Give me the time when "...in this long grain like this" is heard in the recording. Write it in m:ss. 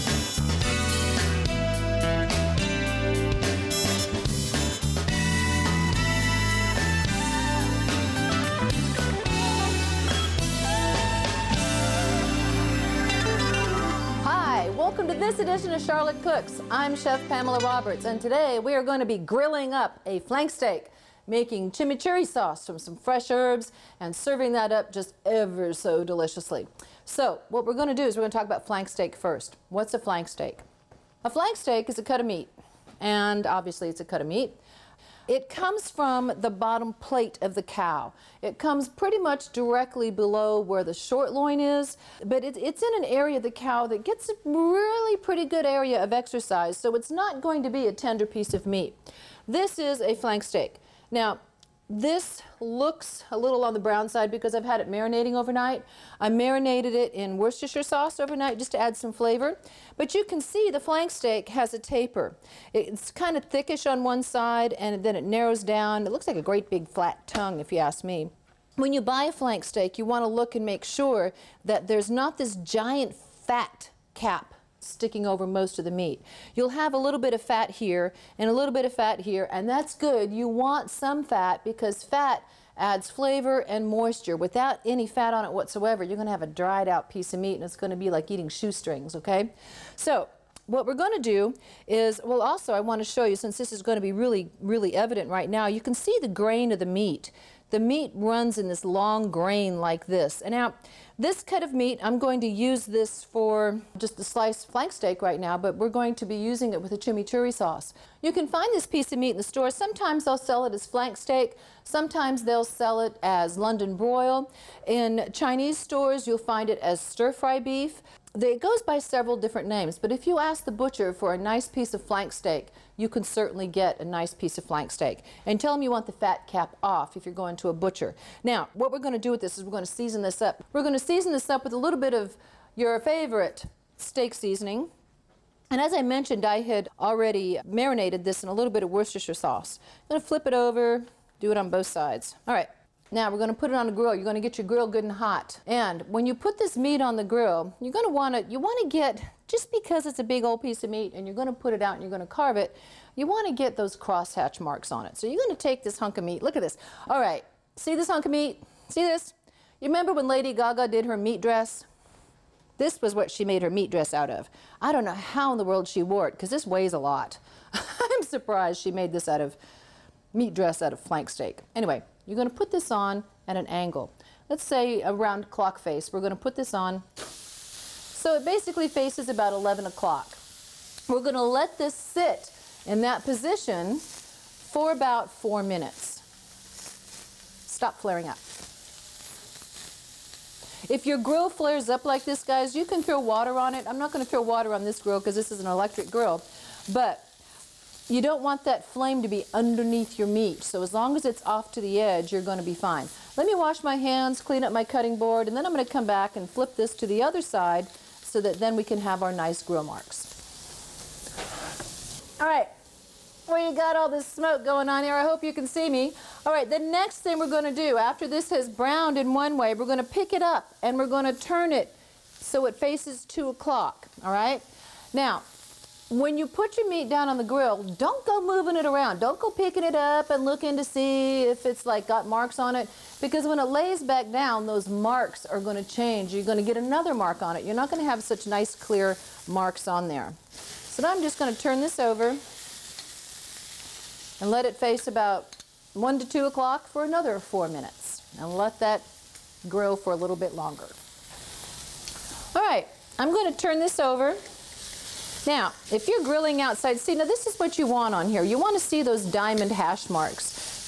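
1:38.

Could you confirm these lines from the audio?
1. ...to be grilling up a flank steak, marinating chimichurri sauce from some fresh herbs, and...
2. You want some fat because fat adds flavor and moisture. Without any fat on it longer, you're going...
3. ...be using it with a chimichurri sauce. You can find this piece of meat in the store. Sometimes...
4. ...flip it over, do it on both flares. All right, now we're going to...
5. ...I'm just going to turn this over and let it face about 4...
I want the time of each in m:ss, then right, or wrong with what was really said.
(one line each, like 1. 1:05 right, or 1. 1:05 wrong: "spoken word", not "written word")
1. 0:18 wrong: "making", not "marinating"
2. 1:20 wrong: "whatsoever", not "longer"
3. 1:46 right
4. 2:20 wrong: "sides", not "flares"
5. 4:01 wrong: "1", not "4".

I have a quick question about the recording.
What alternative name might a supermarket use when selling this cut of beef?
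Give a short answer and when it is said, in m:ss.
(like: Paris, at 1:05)
London broil, at 1:53.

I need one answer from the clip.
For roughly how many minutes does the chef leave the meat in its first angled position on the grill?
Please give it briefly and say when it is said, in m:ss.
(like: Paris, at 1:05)
4, at 3:05.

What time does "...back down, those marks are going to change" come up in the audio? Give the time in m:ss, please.
3:54.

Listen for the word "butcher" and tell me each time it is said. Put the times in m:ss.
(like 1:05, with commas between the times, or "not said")
2:00, 2:07.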